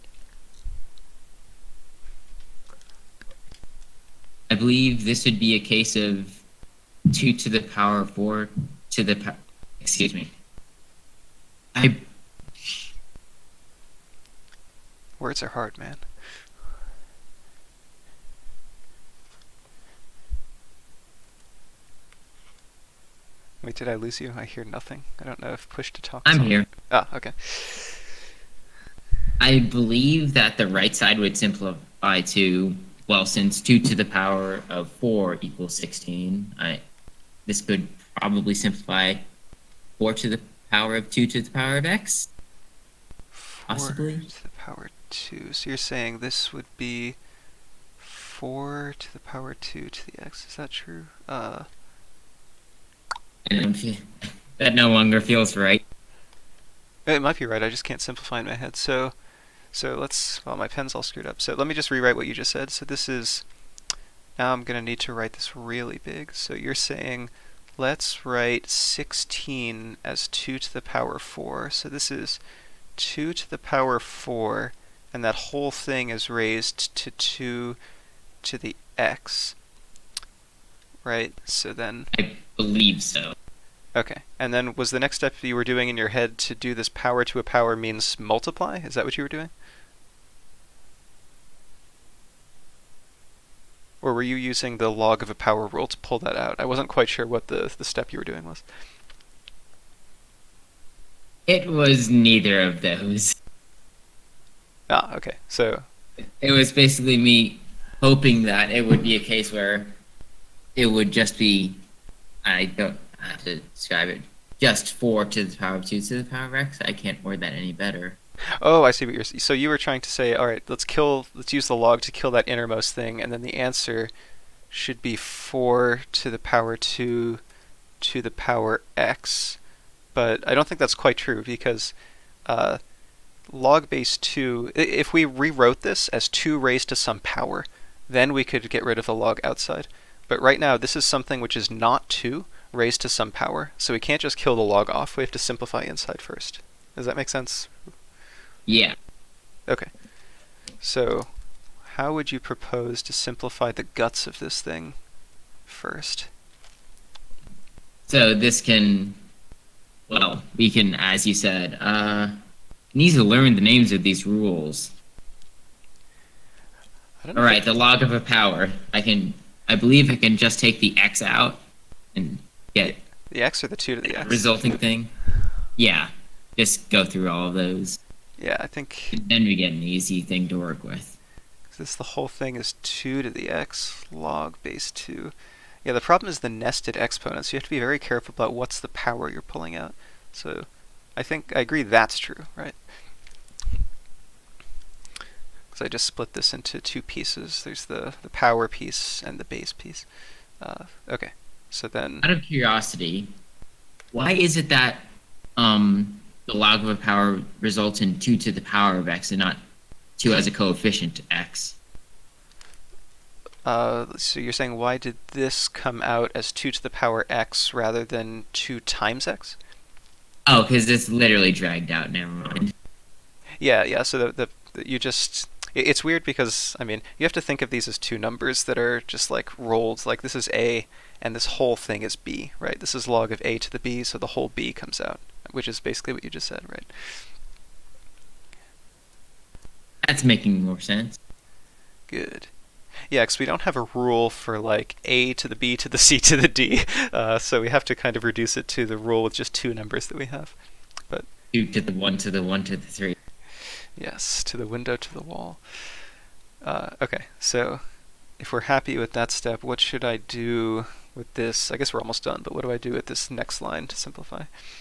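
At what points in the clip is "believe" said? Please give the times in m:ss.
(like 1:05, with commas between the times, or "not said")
0:04, 0:29, 1:22, 2:49.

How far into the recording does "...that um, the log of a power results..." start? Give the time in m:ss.
3:24.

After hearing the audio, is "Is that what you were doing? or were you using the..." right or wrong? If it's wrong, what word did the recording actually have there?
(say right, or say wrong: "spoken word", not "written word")
right.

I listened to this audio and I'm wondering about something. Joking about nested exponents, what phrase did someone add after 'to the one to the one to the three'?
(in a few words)
to the window to the wall.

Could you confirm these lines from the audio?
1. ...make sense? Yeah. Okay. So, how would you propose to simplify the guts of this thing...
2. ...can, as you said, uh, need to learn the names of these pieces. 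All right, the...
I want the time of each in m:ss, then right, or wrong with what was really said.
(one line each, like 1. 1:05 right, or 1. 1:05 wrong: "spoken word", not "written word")
1. 2:27 right
2. 2:40 wrong: "rules", not "pieces".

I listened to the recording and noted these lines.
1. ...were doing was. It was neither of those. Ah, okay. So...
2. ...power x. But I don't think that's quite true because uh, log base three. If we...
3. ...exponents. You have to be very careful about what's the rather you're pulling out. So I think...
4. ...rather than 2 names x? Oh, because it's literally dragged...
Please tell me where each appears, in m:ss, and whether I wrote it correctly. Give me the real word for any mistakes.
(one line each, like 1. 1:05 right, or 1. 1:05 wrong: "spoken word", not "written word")
1. 1:38 right
2. 2:08 wrong: "two", not "three"
3. 3:06 wrong: "power", not "rather"
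4. 3:37 wrong: "times", not "names".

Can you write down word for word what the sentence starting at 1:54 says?
Just four to the power of two to the power of x.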